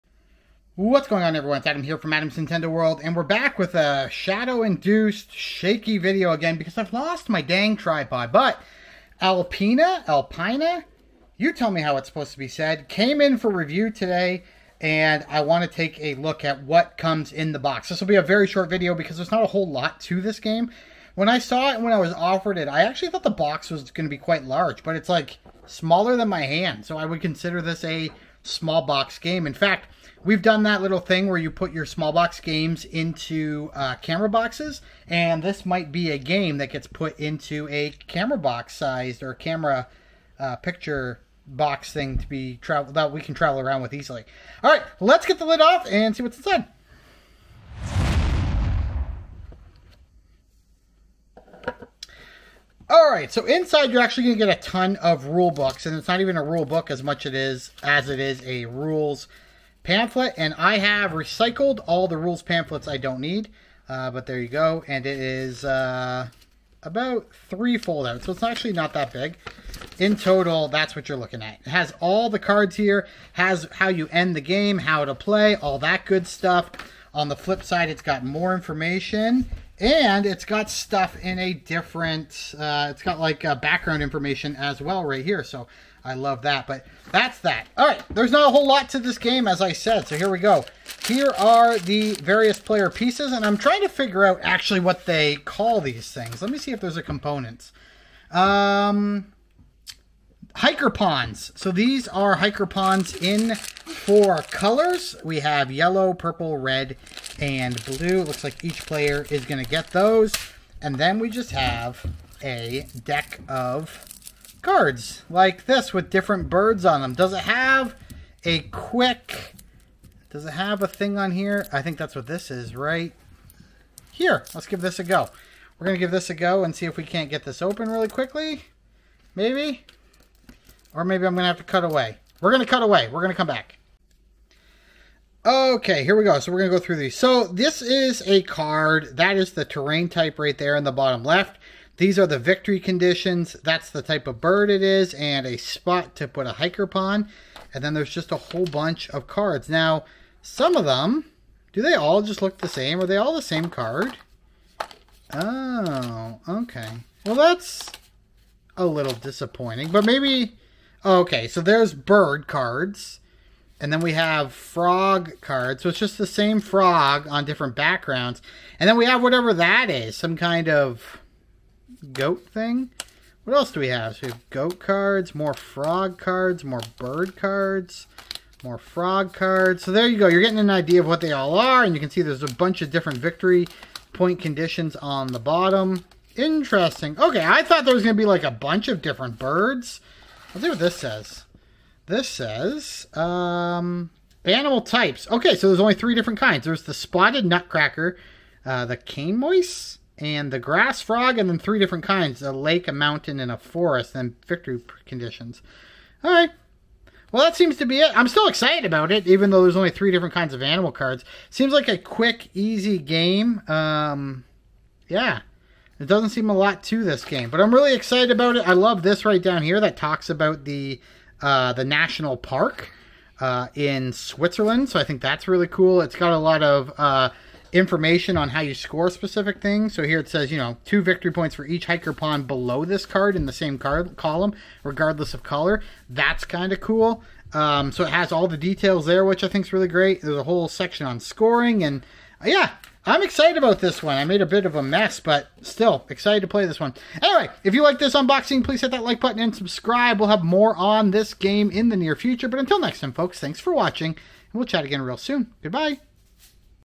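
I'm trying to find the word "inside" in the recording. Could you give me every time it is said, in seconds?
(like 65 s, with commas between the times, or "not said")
46 s, 53 s.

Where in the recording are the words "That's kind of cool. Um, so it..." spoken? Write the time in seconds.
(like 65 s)
236 s.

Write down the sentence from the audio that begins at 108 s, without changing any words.
It looks like each player is going to get those.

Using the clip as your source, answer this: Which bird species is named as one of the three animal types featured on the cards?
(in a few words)
Spotted nutcracker.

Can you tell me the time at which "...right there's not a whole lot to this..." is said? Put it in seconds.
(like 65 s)
87 s.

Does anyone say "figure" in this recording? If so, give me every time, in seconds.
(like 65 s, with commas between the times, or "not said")
93 s.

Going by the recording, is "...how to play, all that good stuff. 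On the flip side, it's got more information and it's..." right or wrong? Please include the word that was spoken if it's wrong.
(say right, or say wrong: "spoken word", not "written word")
right.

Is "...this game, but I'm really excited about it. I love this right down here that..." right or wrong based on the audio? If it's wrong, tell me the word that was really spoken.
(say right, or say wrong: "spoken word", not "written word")
right.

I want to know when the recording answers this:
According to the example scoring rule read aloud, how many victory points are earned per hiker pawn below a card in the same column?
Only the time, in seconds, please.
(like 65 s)
230 s.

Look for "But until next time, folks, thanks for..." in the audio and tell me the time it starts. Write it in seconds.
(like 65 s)
252 s.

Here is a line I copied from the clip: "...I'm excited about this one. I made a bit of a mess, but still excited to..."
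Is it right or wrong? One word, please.
right.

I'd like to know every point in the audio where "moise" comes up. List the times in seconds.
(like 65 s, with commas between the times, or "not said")
199 s.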